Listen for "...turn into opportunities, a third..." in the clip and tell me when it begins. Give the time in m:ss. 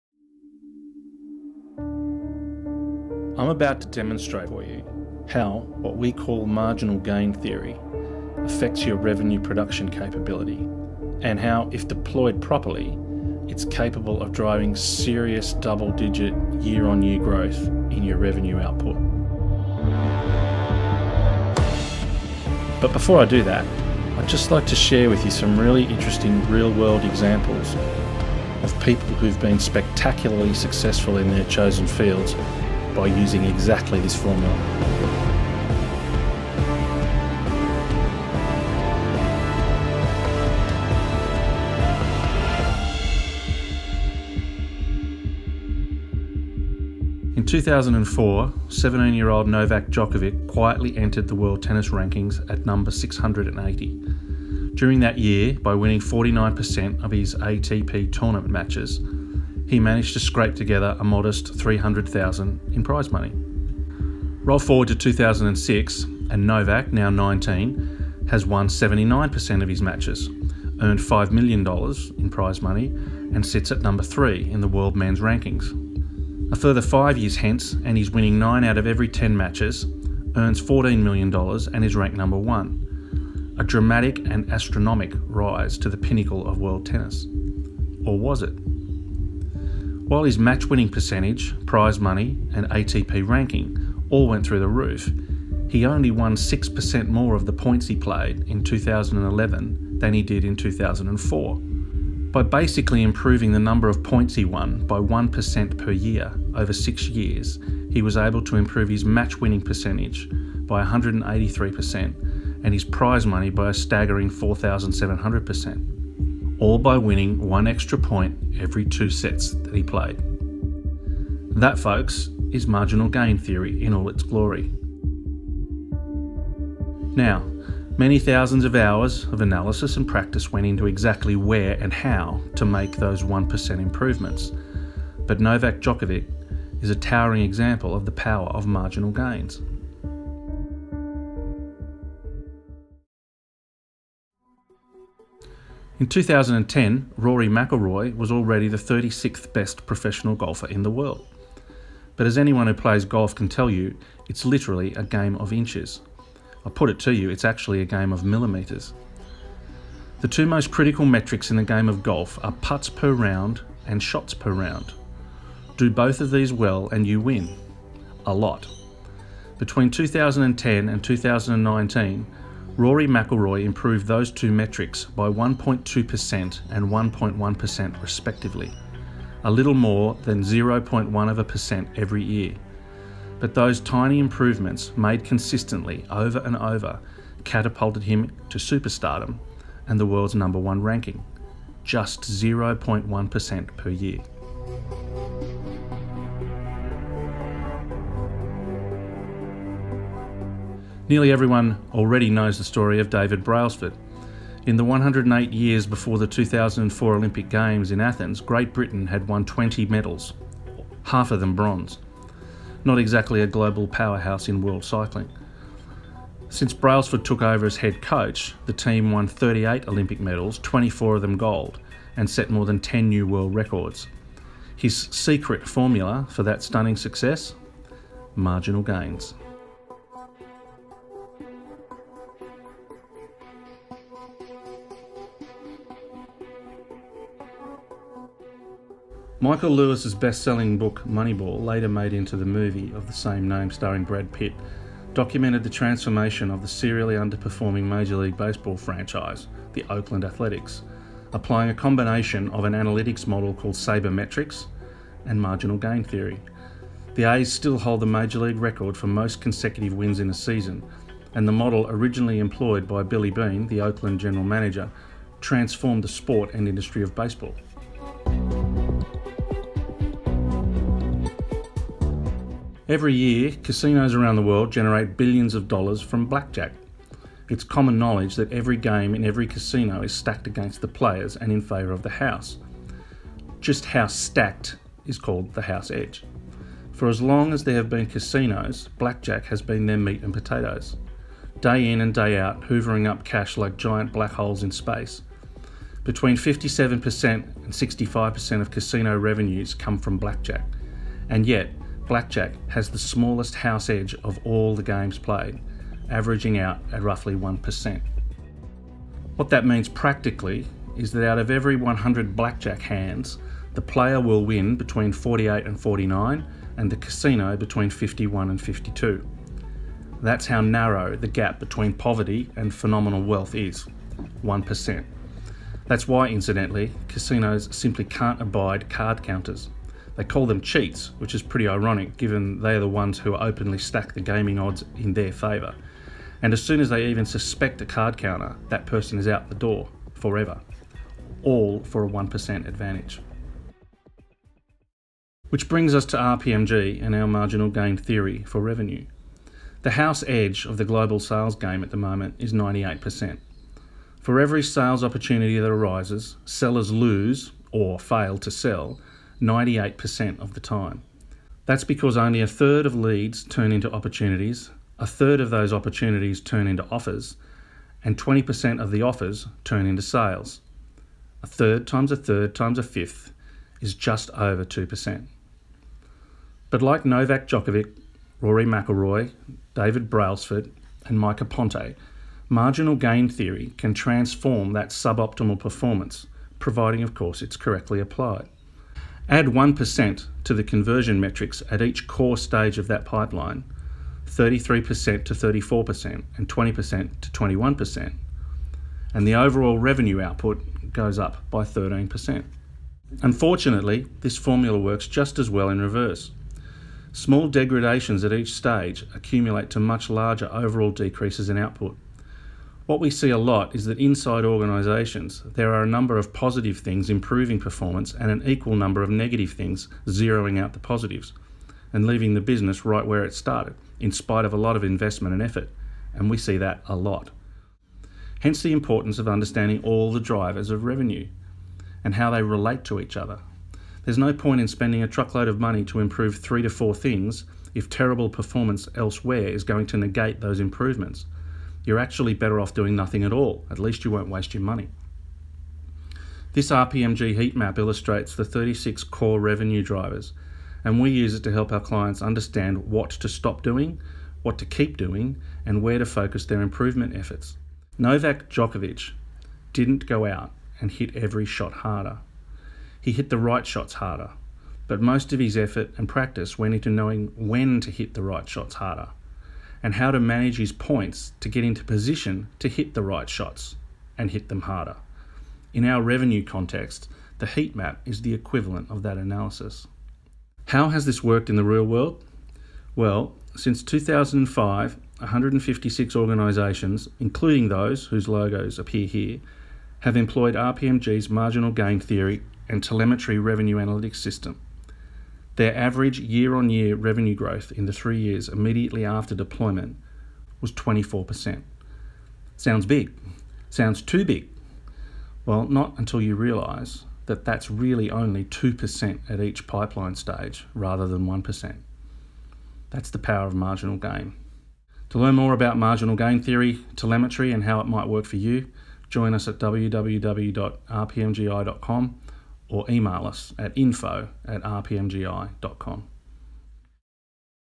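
6:03.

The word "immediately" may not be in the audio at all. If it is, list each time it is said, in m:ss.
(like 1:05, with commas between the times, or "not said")
8:18.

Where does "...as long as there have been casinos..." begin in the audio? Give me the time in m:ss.
4:47.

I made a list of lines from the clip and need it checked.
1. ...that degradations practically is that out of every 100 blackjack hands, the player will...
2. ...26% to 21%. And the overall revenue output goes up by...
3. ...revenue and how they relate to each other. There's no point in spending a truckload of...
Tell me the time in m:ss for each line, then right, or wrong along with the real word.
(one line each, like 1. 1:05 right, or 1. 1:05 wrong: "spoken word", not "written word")
1. 5:09 wrong: "means", not "degradations"
2. 6:36 wrong: "20", not "26"
3. 7:10 right.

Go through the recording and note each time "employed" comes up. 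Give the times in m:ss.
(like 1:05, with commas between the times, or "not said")
4:22, 8:10.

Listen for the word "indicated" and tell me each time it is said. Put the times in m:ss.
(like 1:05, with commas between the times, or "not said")
not said.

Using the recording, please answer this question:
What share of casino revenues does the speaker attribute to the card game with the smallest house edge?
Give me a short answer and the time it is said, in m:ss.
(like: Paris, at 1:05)
57% to 65%, at 4:56.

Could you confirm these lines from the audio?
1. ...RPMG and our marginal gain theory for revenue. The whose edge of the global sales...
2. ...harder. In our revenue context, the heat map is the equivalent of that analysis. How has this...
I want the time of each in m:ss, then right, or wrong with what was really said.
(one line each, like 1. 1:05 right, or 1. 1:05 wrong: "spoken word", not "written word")
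1. 5:46 wrong: "house", not "whose"
2. 7:54 right.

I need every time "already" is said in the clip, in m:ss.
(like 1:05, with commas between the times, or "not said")
2:28, 3:21.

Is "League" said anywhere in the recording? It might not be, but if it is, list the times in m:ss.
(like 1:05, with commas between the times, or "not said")
4:08, 4:18.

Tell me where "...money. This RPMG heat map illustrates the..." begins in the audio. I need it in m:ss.
7:24.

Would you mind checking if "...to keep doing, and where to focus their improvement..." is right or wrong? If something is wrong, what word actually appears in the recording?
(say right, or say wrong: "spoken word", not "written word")
right.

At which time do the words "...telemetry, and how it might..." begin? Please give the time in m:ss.
8:36.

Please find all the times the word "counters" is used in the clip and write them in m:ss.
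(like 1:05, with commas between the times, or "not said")
5:29, 5:38.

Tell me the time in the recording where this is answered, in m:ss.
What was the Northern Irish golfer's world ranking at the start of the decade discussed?
2:28.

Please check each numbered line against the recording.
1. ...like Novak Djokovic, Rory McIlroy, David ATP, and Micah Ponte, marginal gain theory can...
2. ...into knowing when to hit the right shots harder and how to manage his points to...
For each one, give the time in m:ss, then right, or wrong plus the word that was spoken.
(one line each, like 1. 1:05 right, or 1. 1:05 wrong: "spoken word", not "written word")
1. 6:16 wrong: "Brailsford", not "ATP"
2. 7:46 right.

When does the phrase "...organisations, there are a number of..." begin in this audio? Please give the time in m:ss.
6:54.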